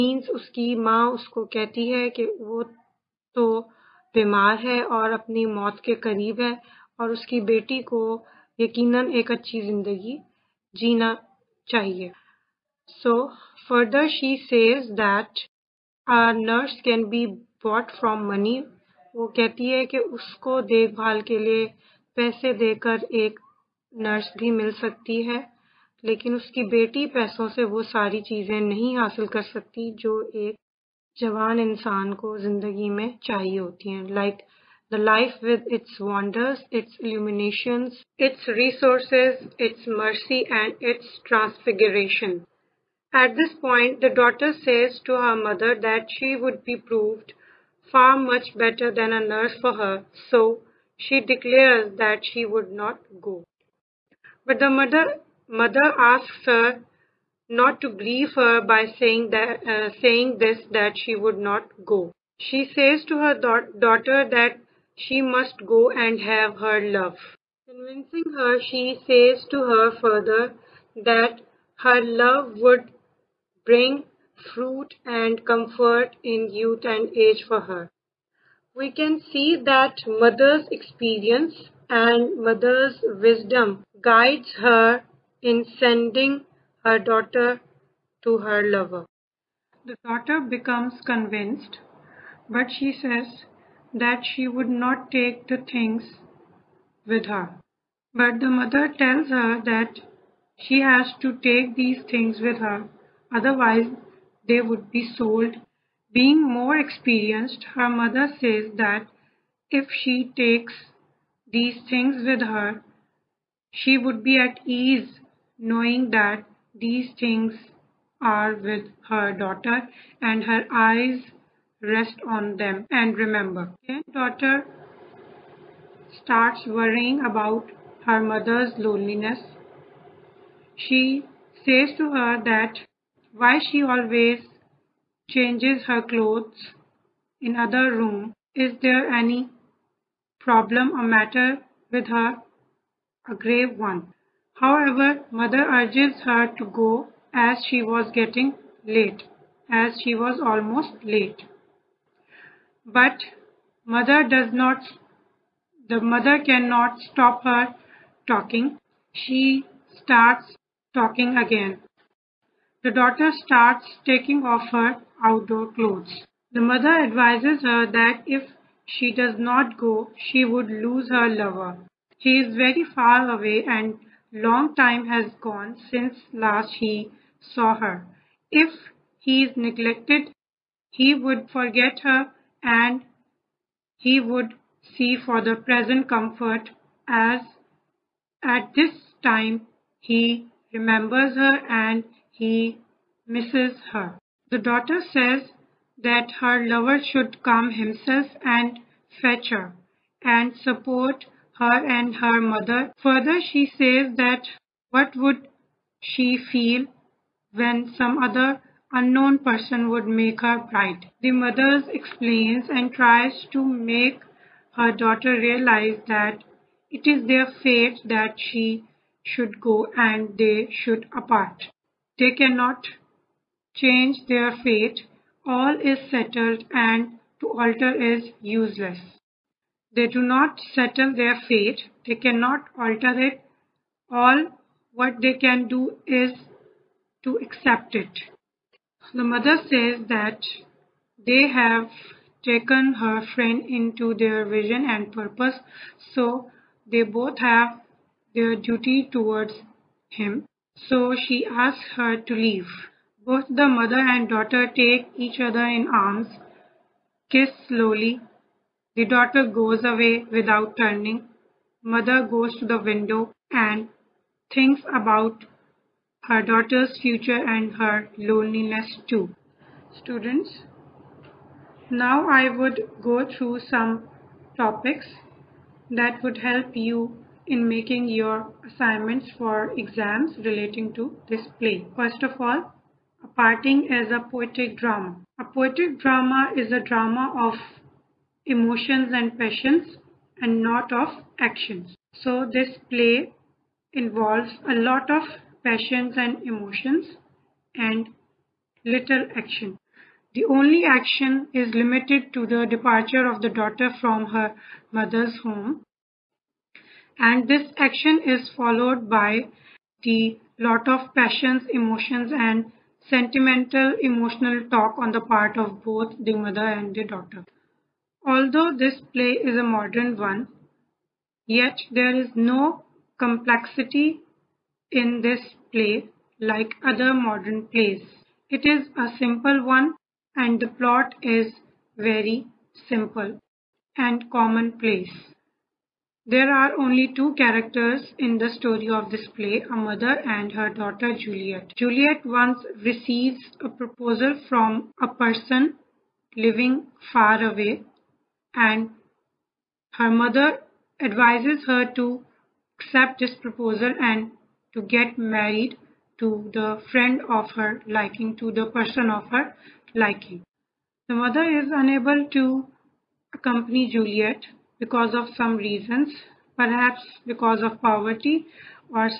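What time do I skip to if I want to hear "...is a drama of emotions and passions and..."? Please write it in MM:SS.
04:46.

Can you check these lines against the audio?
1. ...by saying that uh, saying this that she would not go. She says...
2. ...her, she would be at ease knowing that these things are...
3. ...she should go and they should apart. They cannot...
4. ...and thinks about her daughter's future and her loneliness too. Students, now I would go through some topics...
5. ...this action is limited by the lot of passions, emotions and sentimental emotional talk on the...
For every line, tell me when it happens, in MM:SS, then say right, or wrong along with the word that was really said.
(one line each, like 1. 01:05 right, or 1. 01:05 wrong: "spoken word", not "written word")
1. 00:58 right
2. 01:52 right
3. 03:38 right
4. 04:23 right
5. 05:07 wrong: "followed", not "limited".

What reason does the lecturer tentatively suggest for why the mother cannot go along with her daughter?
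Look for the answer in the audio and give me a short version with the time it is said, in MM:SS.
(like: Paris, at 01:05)
Poverty, at 06:07.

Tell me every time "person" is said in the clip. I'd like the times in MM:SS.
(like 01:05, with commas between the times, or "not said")
03:29, 05:45, 05:58.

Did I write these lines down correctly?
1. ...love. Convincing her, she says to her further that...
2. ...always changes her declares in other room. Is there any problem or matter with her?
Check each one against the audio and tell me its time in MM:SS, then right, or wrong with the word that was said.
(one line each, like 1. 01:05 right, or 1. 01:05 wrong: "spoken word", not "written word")
1. 01:06 right
2. 02:13 wrong: "clothes", not "declares".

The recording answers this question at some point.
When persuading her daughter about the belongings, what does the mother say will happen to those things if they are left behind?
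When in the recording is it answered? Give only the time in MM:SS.
01:44.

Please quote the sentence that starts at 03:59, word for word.
The mother says that they have taken her friend into their vision and purpose, so they both have their duty towards him.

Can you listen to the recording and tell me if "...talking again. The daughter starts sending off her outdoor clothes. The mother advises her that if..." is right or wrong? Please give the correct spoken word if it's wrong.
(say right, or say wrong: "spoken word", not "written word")
wrong: "taking", not "sending".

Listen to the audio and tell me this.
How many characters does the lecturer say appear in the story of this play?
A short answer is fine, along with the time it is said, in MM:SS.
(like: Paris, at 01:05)
2, at 05:37.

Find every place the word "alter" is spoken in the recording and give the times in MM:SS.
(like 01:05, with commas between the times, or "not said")
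03:47, 03:52.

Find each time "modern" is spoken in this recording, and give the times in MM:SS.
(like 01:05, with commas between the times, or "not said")
05:19, 05:27.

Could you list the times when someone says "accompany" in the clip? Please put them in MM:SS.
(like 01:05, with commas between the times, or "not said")
06:03.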